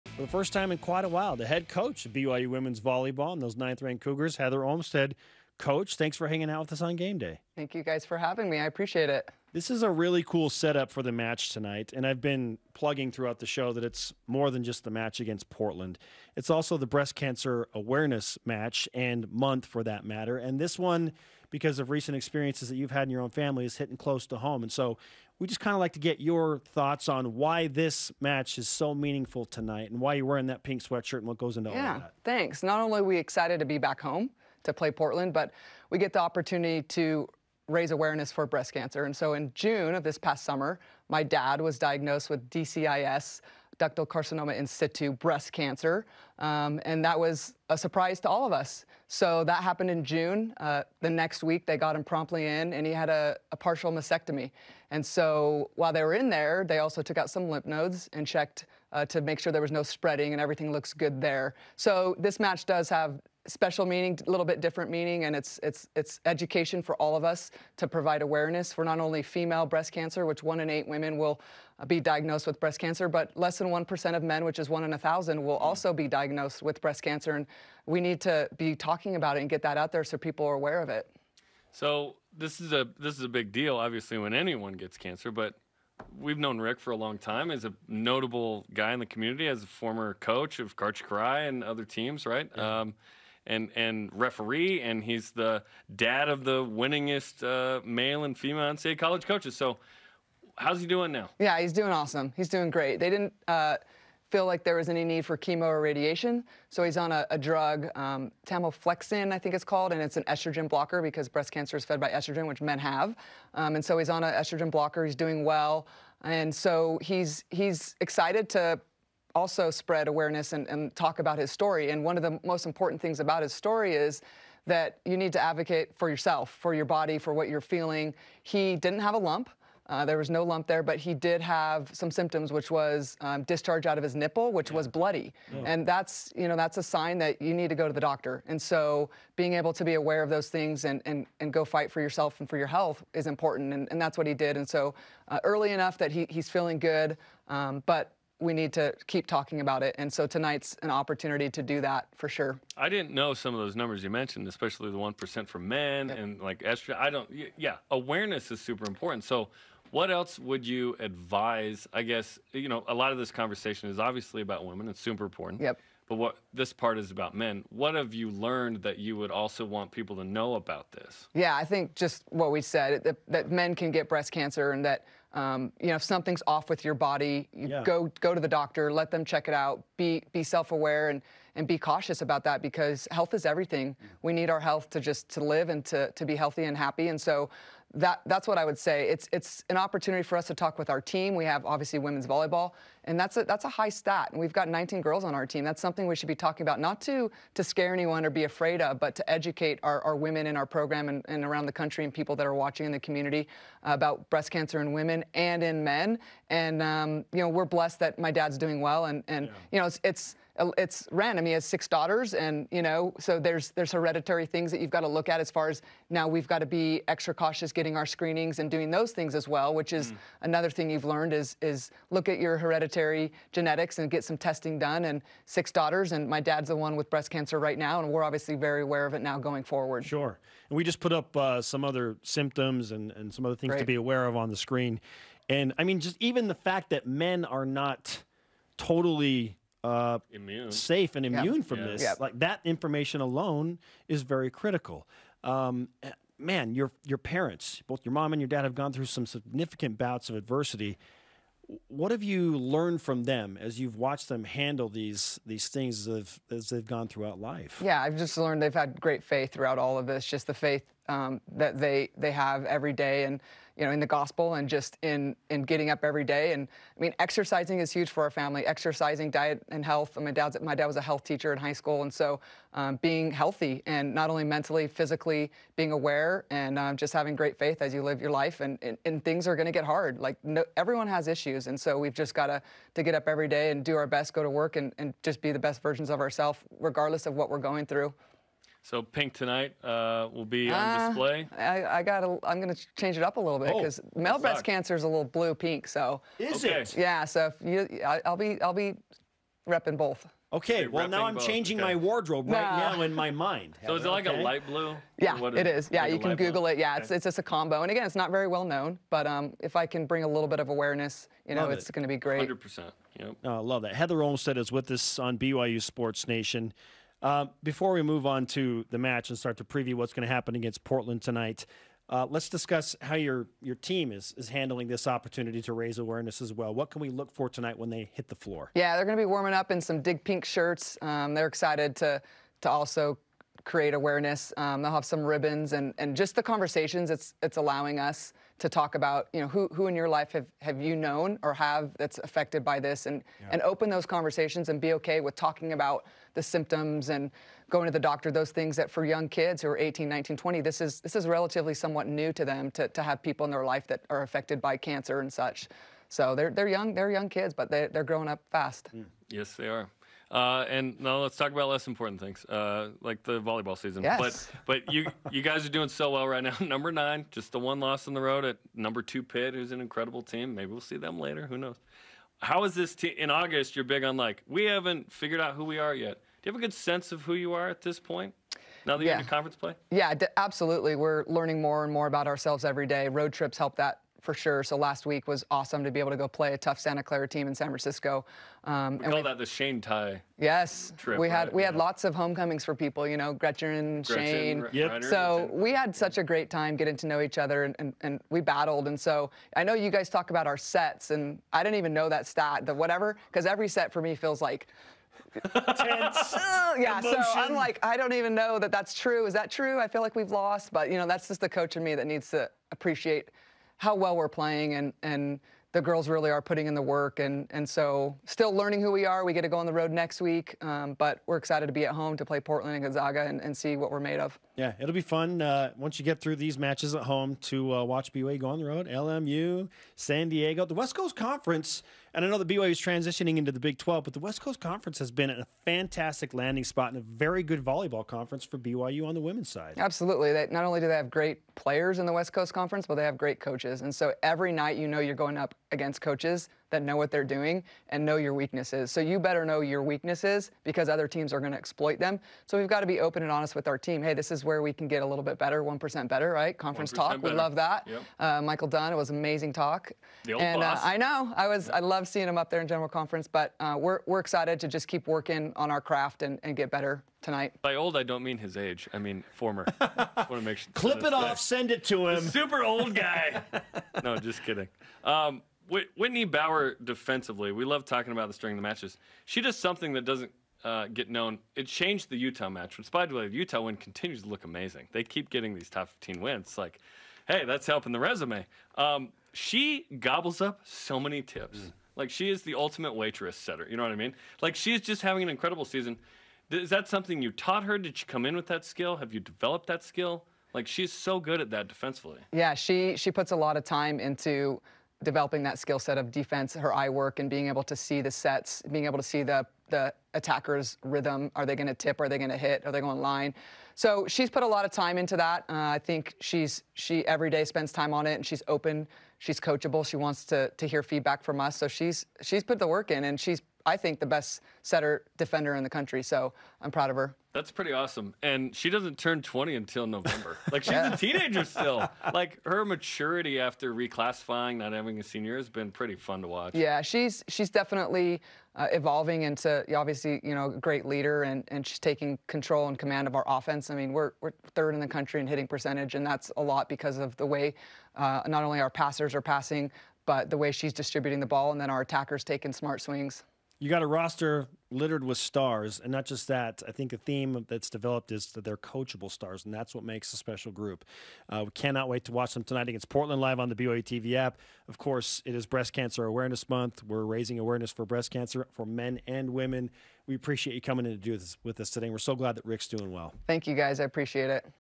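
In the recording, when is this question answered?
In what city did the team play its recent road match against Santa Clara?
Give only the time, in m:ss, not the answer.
6:27.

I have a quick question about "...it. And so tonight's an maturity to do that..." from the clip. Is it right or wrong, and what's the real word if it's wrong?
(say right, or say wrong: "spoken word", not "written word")
wrong: "opportunity", not "maturity".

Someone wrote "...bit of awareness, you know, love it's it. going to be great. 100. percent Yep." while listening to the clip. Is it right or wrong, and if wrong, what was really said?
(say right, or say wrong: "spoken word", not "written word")
right.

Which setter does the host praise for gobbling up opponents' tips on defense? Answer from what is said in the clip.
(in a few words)
Whitney Bower.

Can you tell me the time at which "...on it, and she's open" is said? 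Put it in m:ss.
8:37.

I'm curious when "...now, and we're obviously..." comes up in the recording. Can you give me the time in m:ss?
3:47.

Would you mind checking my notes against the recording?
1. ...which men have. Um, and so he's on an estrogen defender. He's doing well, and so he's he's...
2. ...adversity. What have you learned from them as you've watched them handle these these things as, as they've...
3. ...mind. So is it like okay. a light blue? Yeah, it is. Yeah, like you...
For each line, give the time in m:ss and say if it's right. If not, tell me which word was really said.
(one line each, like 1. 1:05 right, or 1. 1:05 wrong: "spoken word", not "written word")
1. 1:52 wrong: "blocker", not "defender"
2. 4:10 right
3. 5:03 right.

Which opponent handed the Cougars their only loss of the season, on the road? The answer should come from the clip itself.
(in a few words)
Pitt.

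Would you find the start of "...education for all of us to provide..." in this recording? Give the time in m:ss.
1:06.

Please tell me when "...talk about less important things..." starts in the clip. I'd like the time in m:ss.
6:01.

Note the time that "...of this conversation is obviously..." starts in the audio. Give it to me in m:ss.
2:43.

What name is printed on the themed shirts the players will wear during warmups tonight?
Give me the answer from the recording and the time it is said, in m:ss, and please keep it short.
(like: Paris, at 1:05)
Dig Pink, at 5:30.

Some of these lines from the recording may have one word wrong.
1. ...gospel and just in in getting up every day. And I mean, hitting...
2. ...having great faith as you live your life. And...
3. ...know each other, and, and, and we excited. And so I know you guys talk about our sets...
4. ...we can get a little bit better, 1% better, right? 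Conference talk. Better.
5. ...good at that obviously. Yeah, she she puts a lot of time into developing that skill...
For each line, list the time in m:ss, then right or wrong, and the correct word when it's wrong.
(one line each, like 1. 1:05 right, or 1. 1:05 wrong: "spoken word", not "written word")
1. 4:24 wrong: "exercising", not "hitting"
2. 4:37 right
3. 6:37 wrong: "battled", not "excited"
4. 7:34 right
5. 8:21 wrong: "defensively", not "obviously".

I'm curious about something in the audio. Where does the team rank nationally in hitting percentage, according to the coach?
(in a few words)
3rd.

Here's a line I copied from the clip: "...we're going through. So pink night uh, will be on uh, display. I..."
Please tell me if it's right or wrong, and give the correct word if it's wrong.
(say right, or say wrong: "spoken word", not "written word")
wrong: "tonight", not "night".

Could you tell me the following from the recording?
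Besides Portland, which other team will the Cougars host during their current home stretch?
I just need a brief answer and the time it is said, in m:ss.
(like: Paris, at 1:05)
Gonzaga, at 7:02.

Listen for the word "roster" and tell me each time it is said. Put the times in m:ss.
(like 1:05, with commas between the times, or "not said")
9:13.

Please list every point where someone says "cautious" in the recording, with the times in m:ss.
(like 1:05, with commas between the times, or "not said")
3:01, 3:37.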